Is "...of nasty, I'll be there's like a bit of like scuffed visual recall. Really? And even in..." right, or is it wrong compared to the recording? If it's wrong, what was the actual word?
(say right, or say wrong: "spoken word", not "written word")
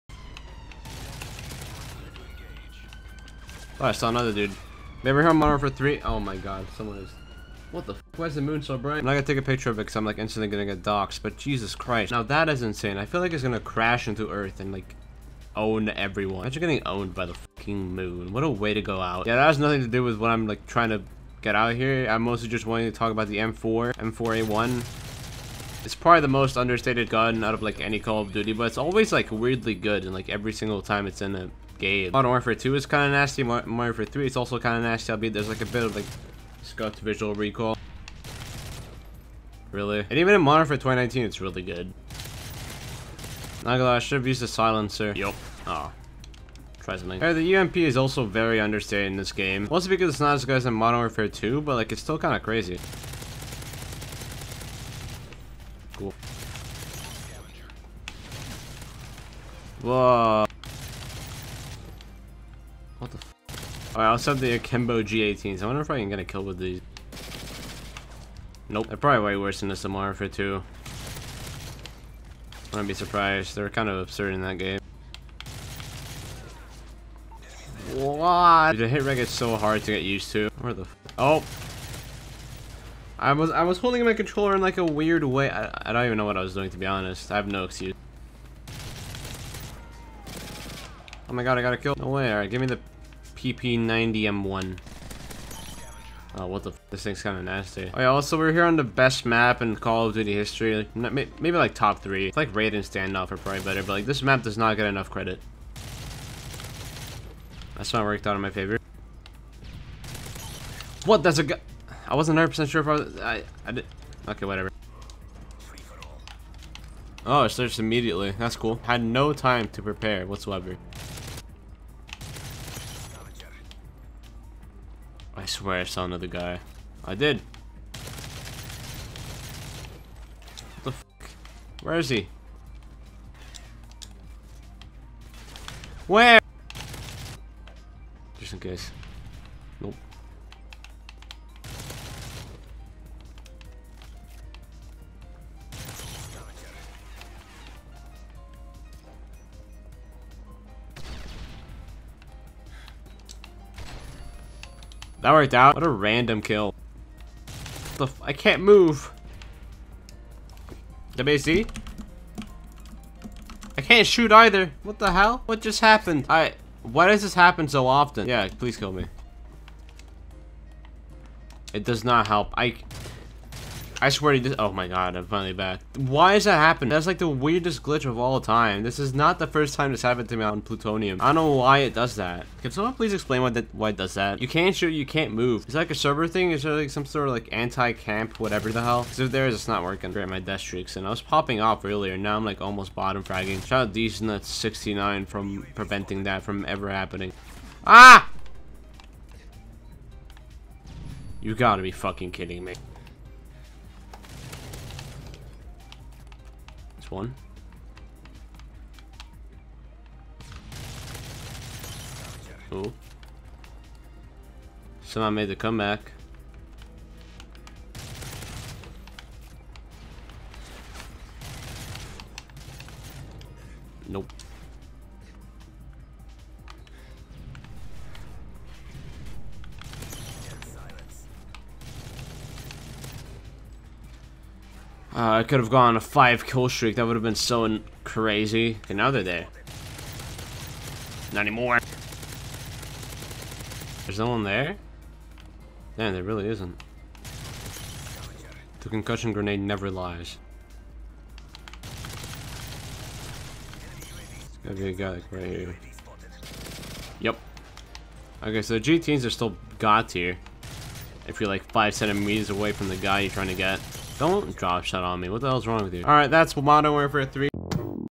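right.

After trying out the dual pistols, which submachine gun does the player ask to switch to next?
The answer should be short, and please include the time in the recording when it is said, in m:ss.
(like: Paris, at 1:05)
PP90M1, at 1:33.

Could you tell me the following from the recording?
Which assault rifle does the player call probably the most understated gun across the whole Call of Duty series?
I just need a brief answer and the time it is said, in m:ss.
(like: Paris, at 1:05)
M4A1, at 0:23.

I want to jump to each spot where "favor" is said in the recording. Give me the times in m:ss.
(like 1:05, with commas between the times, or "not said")
1:48.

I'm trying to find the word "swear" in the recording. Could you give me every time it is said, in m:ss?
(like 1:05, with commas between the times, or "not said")
2:05, 2:54.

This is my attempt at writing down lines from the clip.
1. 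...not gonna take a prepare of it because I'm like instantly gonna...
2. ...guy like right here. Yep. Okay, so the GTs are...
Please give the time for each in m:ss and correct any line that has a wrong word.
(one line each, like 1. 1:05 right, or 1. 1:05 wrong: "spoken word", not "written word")
1. 0:09 wrong: "picture", not "prepare"
2. 4:14 right.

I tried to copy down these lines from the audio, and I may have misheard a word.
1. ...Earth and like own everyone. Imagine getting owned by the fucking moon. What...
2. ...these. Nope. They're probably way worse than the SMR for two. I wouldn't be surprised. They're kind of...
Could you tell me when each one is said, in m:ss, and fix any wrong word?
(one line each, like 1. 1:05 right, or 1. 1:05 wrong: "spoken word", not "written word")
1. 0:14 right
2. 1:06 right.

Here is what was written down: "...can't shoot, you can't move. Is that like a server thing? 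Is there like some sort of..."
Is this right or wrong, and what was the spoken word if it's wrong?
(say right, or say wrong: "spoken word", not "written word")
right.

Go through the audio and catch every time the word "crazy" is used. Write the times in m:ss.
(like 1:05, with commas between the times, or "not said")
0:52, 3:58.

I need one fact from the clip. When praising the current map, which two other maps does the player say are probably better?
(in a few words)
Raid and Standoff.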